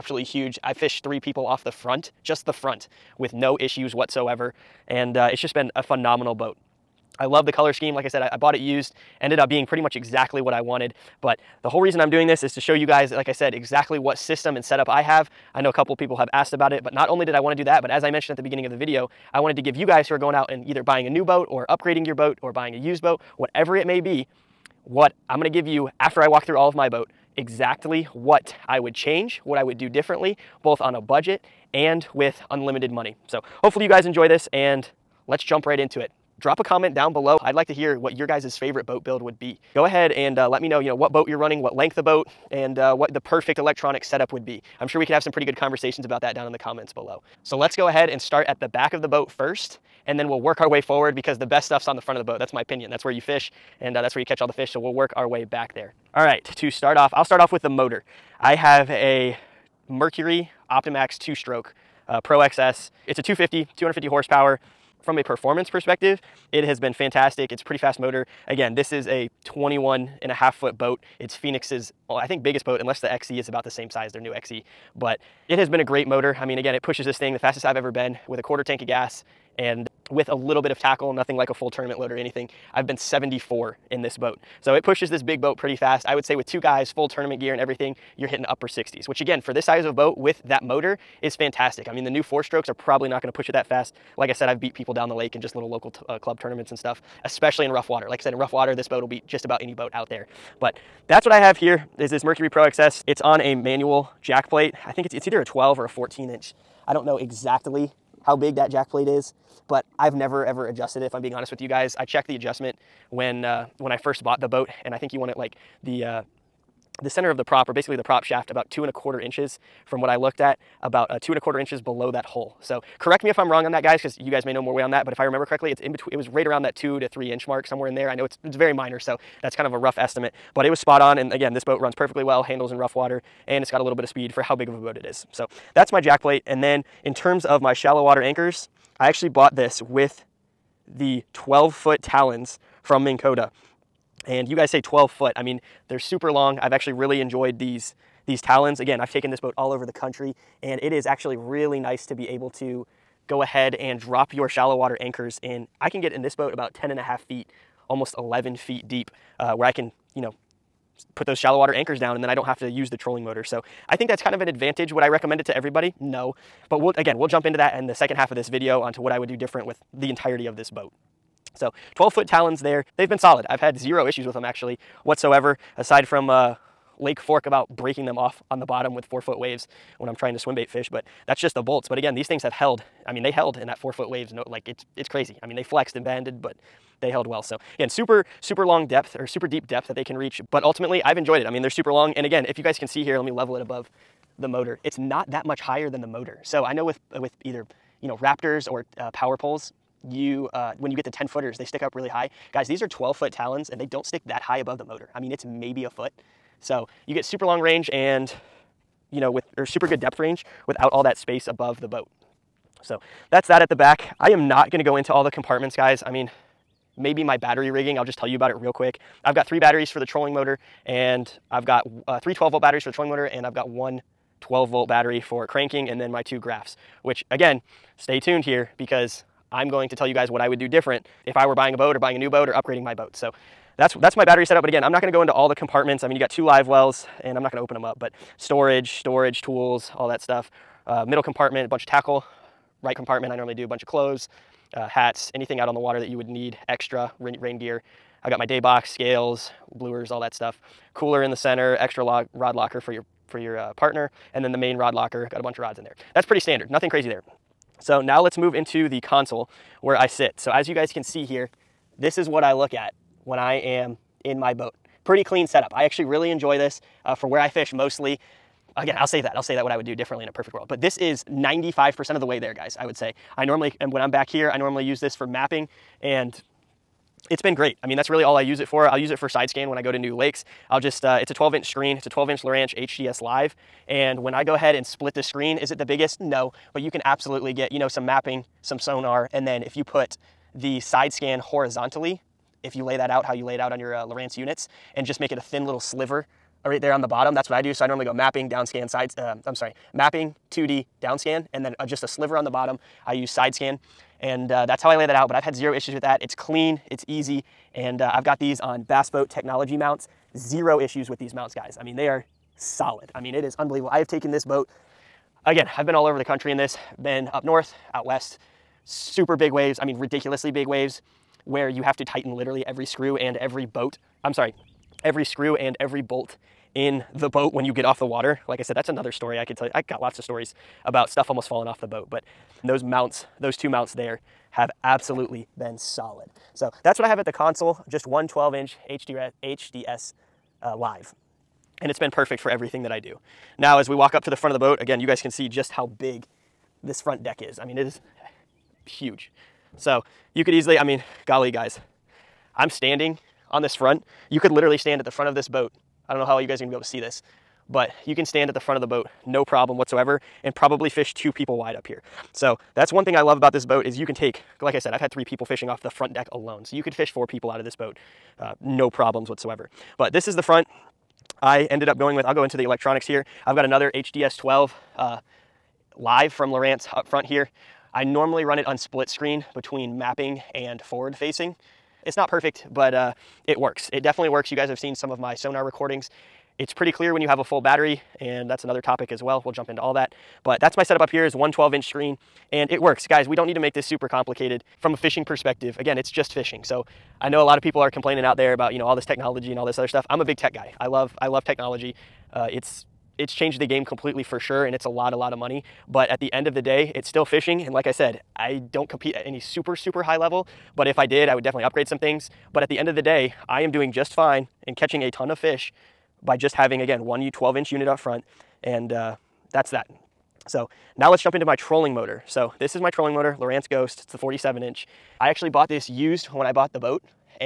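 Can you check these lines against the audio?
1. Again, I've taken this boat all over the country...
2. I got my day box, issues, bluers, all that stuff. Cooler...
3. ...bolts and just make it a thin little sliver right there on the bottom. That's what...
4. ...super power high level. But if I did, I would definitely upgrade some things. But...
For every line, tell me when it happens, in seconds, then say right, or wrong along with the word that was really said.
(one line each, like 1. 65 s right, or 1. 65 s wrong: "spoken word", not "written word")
1. 148 s right
2. 248 s wrong: "scales", not "issues"
3. 294 s wrong: "units", not "bolts"
4. 409 s wrong: "super", not "power".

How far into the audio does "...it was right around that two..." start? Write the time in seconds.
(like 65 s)
126 s.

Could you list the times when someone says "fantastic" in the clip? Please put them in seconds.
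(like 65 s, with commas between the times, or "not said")
66 s, 91 s.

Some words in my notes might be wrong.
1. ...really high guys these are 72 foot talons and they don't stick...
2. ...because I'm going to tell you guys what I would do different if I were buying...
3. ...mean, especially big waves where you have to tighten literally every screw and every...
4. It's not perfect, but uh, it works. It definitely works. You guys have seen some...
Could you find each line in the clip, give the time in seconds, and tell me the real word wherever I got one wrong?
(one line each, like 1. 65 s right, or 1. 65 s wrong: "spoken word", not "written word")
1. 201 s wrong: "12", not "72"
2. 228 s right
3. 319 s wrong: "ridiculously", not "especially"
4. 382 s right.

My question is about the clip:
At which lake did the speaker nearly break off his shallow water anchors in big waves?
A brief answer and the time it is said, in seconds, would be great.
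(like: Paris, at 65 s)
Lake Fork, at 176 s.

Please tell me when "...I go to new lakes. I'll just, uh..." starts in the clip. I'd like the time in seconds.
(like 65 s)
279 s.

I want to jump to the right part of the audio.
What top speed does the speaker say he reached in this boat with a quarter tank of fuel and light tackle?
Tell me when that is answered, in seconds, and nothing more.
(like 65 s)
82 s.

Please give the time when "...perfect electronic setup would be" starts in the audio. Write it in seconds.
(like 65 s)
43 s.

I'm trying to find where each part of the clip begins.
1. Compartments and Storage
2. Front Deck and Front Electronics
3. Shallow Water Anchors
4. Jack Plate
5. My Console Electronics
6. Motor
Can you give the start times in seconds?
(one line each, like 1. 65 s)
1. 214 s
2. 343 s
3. 136 s
4. 102 s
5. 258 s
6. 47 s.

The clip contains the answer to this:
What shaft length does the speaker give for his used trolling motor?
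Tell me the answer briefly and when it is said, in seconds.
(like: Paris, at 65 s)
47 inch, at 424 s.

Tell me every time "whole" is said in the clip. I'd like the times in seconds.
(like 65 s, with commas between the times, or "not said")
11 s.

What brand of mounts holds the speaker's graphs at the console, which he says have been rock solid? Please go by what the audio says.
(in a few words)
Bass Boat Technology.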